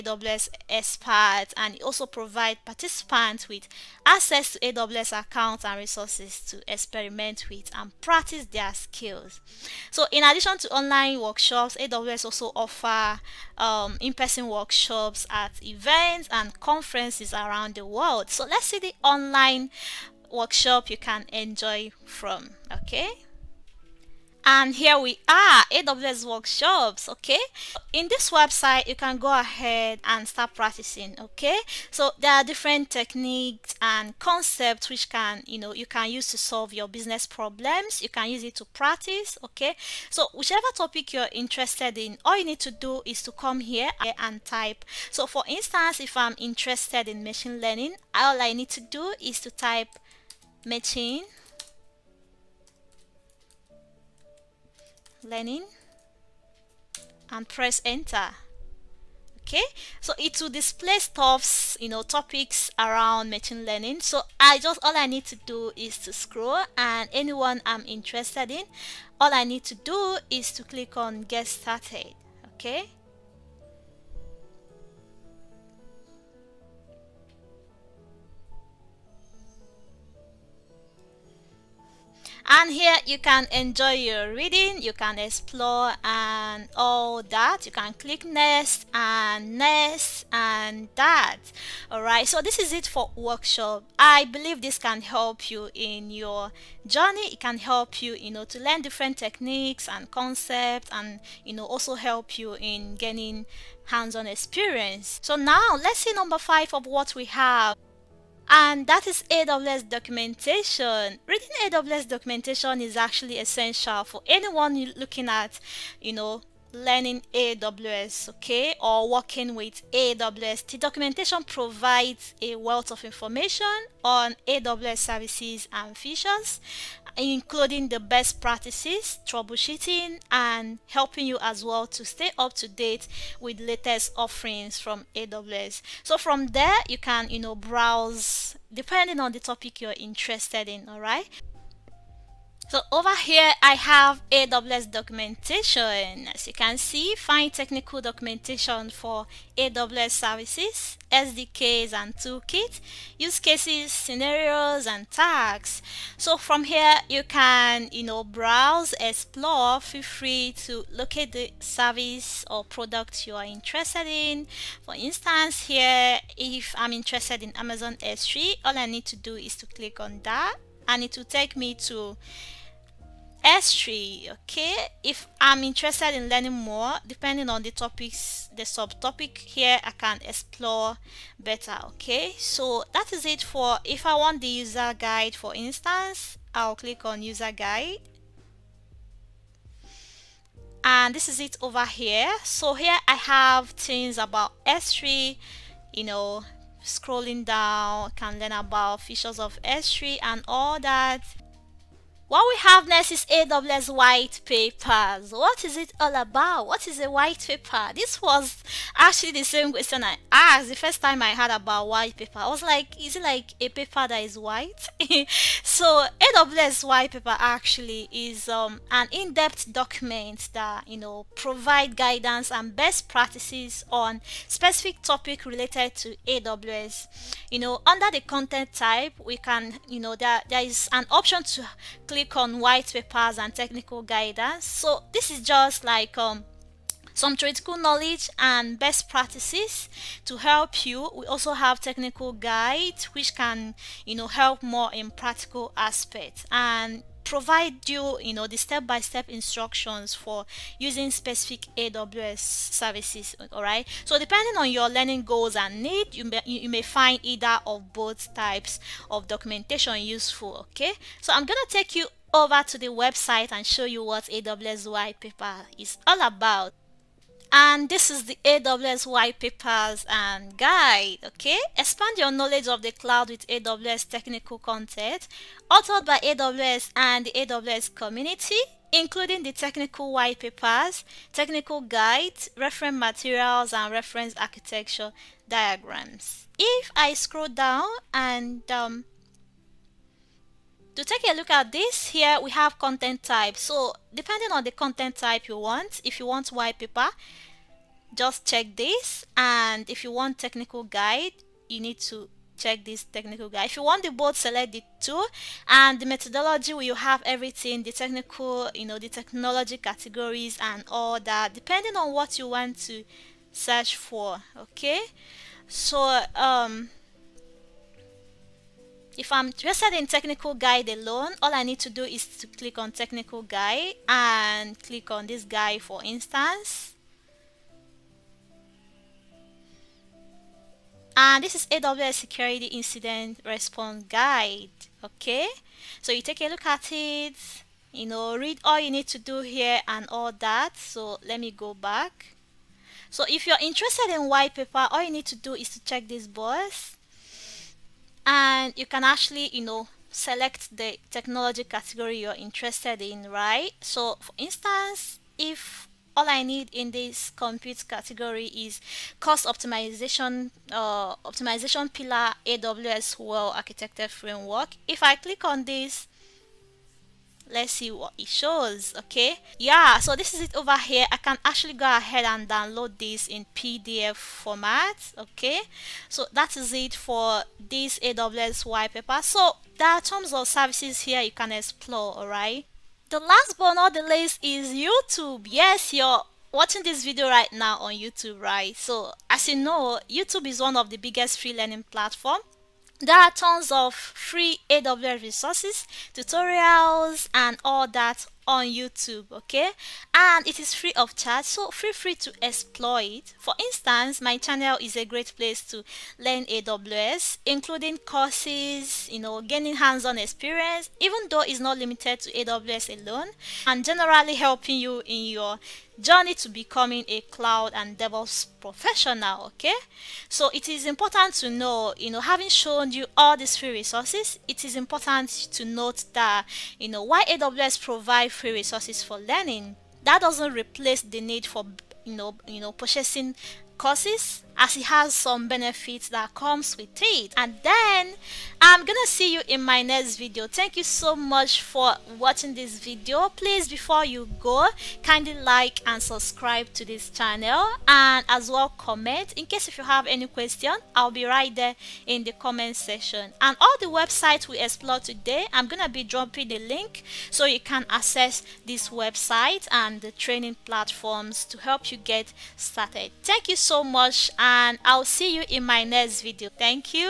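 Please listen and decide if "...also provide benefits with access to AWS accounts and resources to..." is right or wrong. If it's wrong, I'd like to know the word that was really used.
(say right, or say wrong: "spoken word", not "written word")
wrong: "participants", not "benefits".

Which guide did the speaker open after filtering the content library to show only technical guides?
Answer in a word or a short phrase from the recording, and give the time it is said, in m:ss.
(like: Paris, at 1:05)
AWS security incident response guide, at 5:31.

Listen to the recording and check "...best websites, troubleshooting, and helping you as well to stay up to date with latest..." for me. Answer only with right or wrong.
wrong.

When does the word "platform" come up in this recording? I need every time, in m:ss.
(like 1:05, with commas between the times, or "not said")
6:31, 7:40.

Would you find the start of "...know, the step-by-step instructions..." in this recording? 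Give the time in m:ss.
4:08.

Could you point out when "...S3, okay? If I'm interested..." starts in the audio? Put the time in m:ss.
2:53.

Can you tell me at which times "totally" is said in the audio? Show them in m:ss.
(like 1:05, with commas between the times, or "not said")
not said.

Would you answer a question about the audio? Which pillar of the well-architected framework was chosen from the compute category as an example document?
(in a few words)
Cost optimization.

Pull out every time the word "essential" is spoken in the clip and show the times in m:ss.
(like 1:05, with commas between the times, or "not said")
1:53.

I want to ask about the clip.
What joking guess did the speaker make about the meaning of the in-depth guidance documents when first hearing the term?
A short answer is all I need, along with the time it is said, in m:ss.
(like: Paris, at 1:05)
A paper that is white, at 3:33.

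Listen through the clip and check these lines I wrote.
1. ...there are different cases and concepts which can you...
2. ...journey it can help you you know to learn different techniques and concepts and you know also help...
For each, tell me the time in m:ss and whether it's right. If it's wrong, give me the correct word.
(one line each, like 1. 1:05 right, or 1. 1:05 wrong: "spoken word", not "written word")
1. 0:32 wrong: "techniques", not "cases"
2. 1:36 right.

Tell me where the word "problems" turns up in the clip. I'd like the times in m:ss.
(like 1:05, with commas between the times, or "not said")
0:37.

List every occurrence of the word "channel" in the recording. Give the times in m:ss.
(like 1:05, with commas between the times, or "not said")
6:44, 7:27.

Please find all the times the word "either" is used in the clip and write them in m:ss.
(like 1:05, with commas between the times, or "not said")
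4:17.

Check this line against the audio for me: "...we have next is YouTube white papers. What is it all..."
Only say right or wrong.
wrong.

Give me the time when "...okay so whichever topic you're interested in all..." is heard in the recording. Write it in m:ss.
0:39.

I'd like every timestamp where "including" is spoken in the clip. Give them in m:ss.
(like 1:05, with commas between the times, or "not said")
2:07, 4:38, 6:47.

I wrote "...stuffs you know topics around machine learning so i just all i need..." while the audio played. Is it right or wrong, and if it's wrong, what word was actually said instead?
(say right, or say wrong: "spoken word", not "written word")
right.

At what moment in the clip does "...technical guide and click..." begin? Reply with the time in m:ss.
5:22.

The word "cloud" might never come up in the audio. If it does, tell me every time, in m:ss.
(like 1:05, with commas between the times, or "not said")
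4:32, 6:57.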